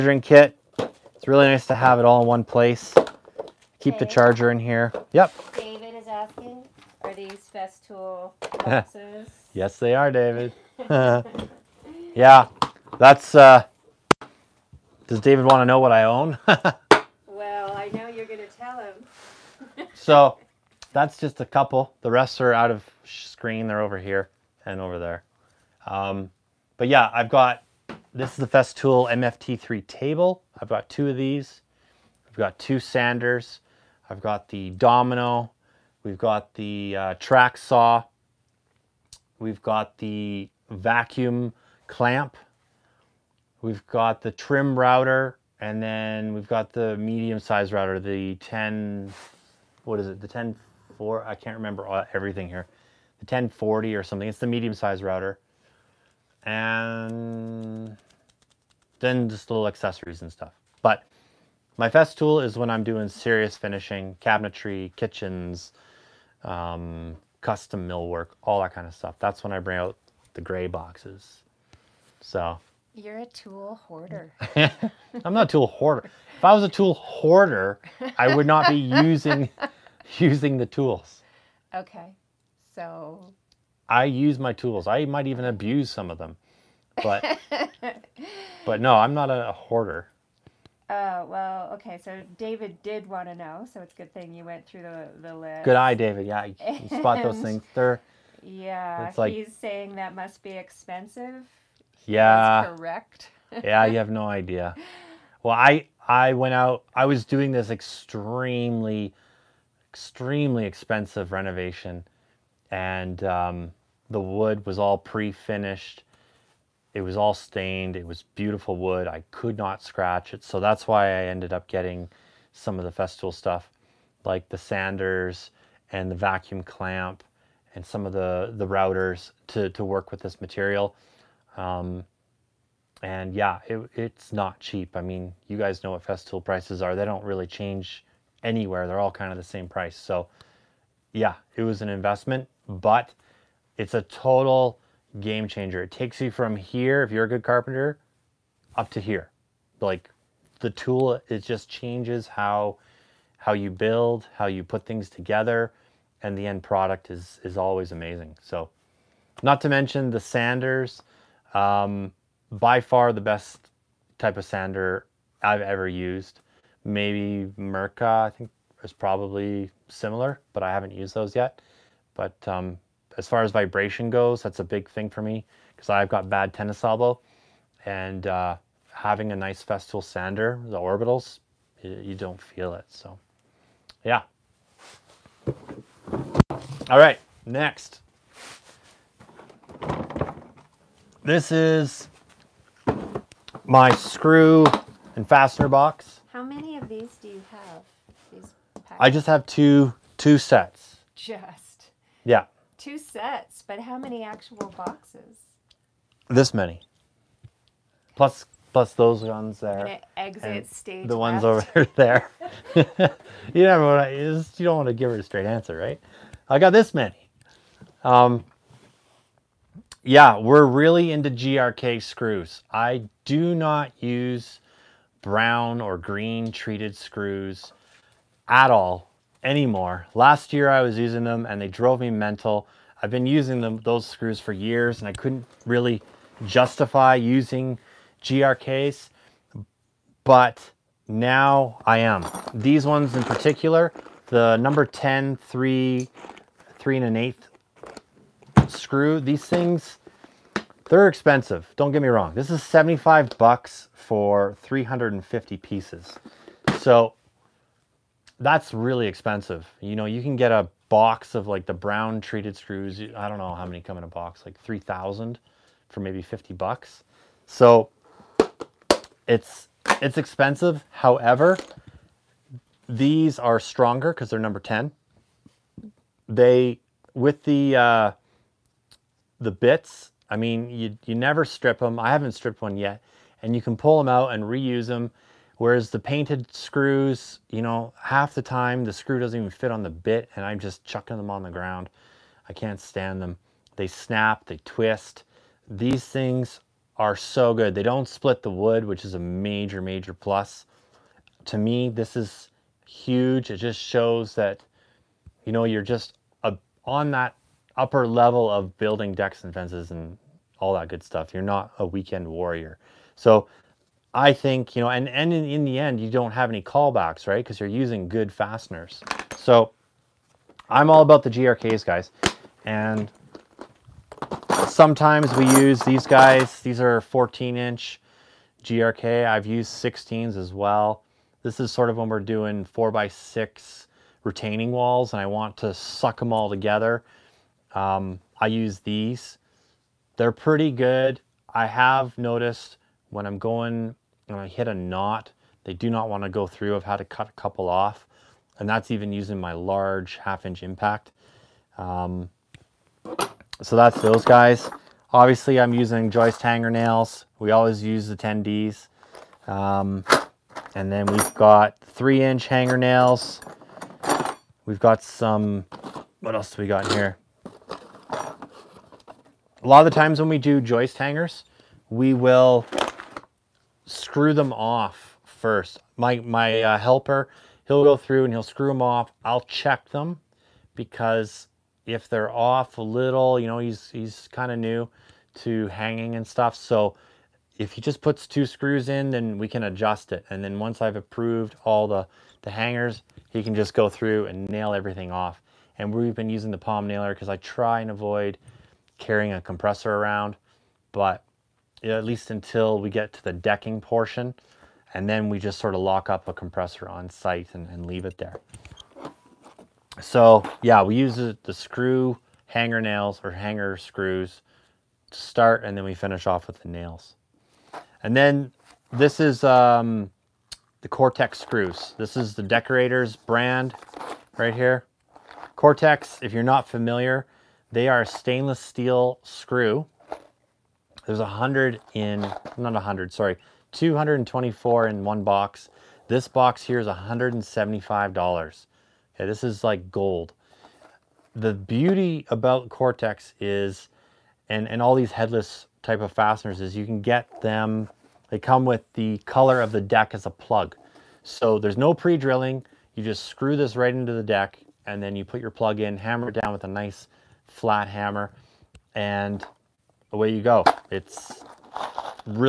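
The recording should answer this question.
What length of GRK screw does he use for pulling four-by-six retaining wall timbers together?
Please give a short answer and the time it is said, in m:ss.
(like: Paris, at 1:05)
14 inch, at 5:27.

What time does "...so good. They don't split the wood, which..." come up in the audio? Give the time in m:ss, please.
4:57.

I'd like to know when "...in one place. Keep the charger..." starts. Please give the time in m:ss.
0:02.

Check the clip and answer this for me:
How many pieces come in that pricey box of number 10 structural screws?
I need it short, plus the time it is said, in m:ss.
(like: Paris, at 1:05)
350, at 4:14.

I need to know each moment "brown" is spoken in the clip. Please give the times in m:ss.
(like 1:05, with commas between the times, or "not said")
3:45, 4:21.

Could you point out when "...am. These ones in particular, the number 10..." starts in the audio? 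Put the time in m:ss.
4:01.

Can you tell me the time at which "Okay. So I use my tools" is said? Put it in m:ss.
1:21.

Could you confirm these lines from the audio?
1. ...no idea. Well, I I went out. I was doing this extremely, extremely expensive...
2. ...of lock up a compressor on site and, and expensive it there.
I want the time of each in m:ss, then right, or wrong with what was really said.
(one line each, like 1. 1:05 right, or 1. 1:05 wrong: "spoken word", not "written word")
1. 1:44 right
2. 6:45 wrong: "leave", not "expensive".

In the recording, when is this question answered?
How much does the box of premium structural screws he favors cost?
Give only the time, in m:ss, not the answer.
4:12.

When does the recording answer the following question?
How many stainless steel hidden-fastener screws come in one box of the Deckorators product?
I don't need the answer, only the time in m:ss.
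7:13.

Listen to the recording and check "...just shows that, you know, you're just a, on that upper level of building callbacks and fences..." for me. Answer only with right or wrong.
wrong.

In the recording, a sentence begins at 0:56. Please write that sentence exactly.
And then just little accessories and stuff.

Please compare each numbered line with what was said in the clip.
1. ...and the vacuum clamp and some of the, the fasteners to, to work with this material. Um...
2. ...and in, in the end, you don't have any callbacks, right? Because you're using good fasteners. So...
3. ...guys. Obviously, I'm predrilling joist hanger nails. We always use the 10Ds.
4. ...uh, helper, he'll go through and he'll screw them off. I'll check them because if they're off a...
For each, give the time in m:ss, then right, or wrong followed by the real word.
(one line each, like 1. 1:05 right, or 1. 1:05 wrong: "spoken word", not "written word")
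1. 2:05 wrong: "routers", not "fasteners"
2. 5:15 right
3. 5:54 wrong: "using", not "predrilling"
4. 6:16 right.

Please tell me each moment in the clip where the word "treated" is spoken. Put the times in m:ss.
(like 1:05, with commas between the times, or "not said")
3:46, 4:22.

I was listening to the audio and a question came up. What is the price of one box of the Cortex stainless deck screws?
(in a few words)
$175.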